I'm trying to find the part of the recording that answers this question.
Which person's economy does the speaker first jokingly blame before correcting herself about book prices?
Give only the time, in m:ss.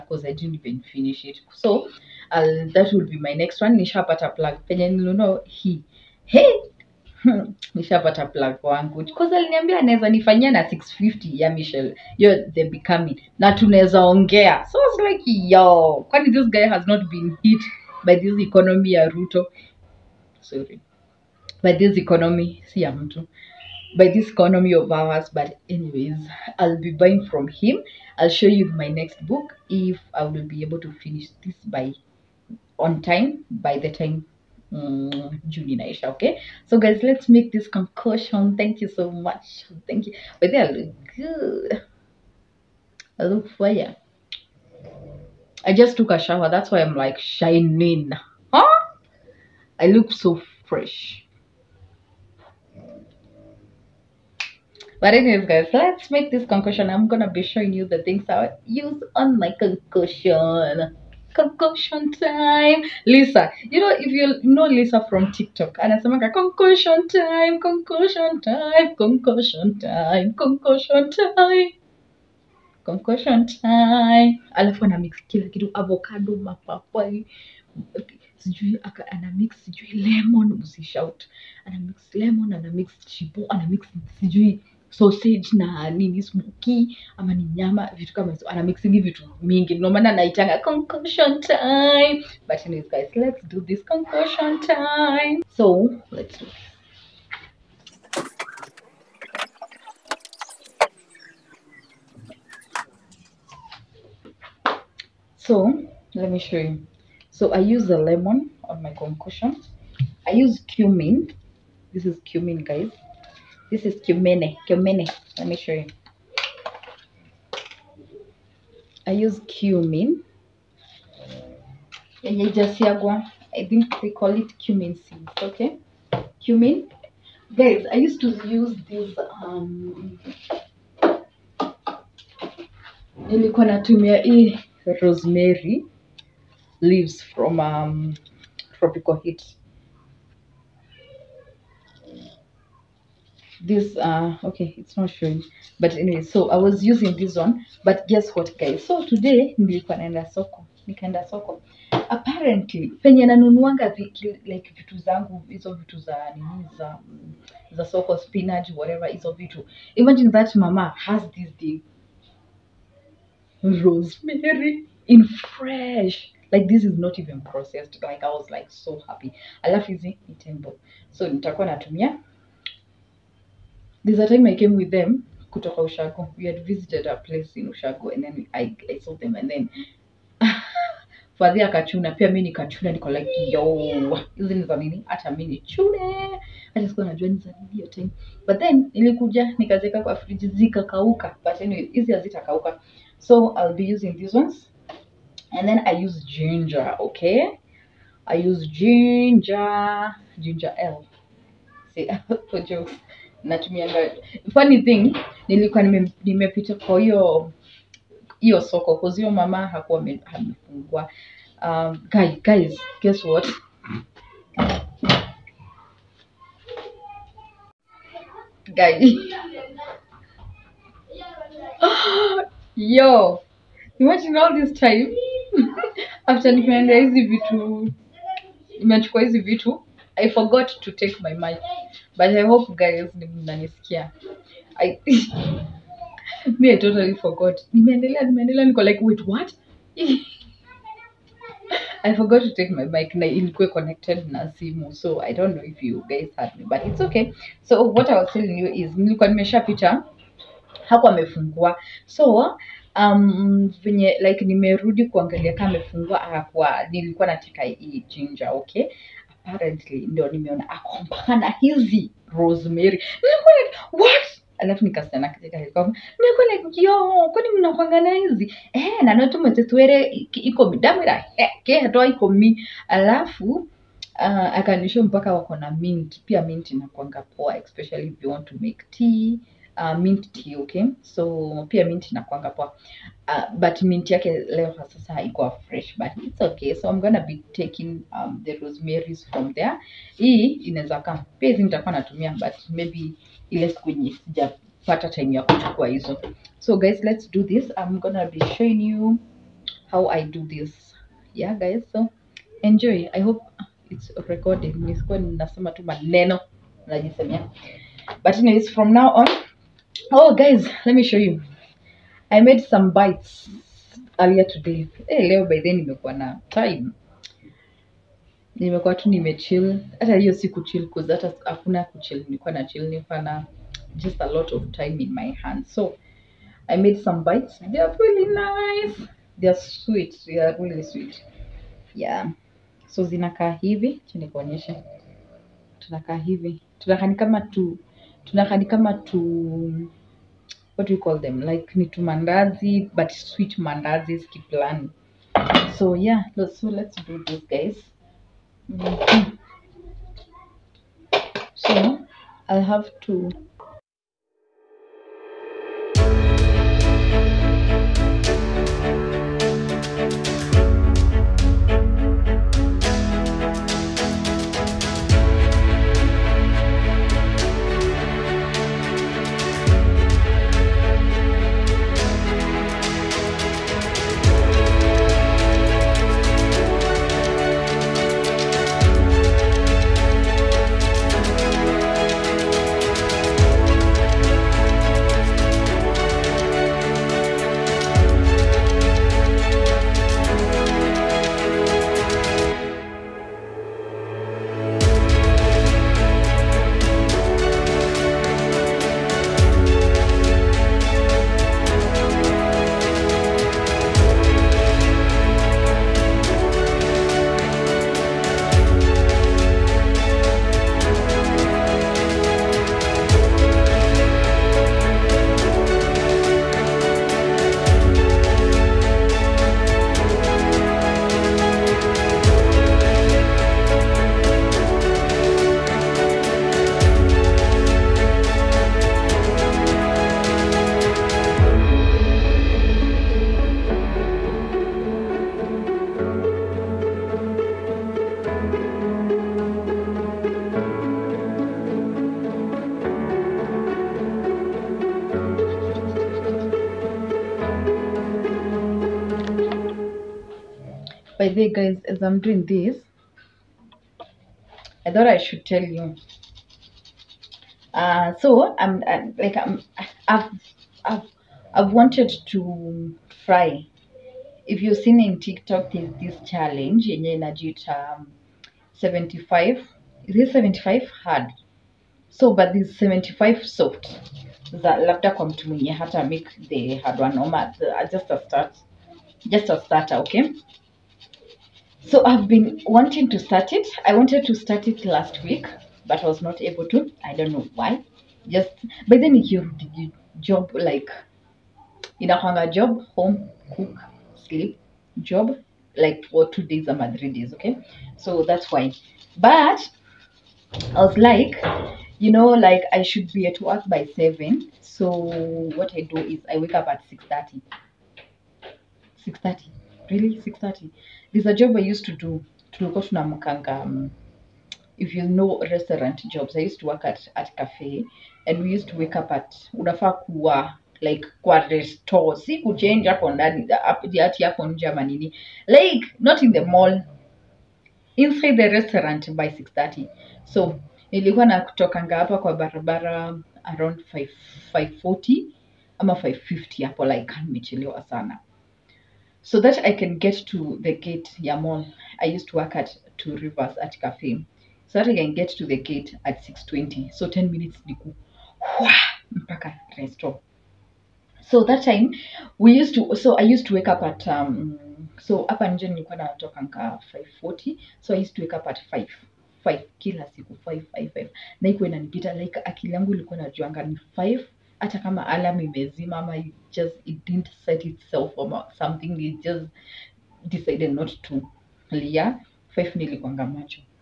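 0:19.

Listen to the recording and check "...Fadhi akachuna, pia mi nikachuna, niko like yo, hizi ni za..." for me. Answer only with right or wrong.
right.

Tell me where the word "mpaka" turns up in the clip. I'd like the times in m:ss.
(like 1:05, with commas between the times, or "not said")
4:35, 9:09.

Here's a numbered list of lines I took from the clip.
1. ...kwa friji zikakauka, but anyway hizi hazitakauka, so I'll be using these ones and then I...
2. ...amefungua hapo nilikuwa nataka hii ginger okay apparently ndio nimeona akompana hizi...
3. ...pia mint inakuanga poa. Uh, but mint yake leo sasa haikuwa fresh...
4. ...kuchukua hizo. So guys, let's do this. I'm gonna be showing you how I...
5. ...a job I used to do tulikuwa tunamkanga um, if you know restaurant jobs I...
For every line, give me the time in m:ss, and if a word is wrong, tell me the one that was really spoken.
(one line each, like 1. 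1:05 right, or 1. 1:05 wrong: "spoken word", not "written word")
1. 3:10 right
2. 4:15 right
3. 4:41 right
4. 4:55 right
5. 8:31 right.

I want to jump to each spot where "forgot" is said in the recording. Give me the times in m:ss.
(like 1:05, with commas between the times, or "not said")
3:50, 3:57, 4:02.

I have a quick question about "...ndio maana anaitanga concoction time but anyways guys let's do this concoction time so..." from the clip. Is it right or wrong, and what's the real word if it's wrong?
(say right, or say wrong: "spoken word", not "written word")
right.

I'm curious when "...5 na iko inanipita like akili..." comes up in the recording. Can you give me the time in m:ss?
9:20.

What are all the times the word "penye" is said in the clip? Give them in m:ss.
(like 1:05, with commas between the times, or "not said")
0:04, 2:33.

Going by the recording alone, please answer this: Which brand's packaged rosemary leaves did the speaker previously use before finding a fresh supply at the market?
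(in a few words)
Tropical Heat.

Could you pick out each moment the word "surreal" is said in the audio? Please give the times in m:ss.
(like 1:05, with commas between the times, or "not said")
not said.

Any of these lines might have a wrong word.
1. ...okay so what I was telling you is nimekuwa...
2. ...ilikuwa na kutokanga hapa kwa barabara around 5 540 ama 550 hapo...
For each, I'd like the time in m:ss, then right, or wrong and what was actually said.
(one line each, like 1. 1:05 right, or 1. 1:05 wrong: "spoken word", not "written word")
1. 4:06 wrong: "nilikuwa", not "nimekuwa"
2. 8:50 right.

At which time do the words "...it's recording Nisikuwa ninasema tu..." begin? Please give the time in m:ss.
5:03.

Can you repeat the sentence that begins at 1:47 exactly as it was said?
So I use a lemon on my concoction.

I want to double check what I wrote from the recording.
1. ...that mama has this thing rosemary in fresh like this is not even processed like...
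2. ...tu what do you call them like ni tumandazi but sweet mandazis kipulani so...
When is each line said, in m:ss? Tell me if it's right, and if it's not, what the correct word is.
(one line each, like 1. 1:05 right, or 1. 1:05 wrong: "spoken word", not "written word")
1. 2:40 right
2. 5:38 right.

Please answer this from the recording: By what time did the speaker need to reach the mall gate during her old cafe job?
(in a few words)
6:20.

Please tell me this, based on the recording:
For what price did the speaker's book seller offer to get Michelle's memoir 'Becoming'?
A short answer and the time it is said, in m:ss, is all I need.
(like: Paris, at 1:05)
650, at 0:10.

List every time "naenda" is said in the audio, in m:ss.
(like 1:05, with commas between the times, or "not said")
2:29.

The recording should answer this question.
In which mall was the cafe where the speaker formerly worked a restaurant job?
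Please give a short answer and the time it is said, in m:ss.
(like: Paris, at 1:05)
Two Rivers, at 9:02.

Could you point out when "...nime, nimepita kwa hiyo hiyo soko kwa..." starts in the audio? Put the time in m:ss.
3:25.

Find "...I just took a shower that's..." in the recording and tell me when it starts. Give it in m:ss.
0:45.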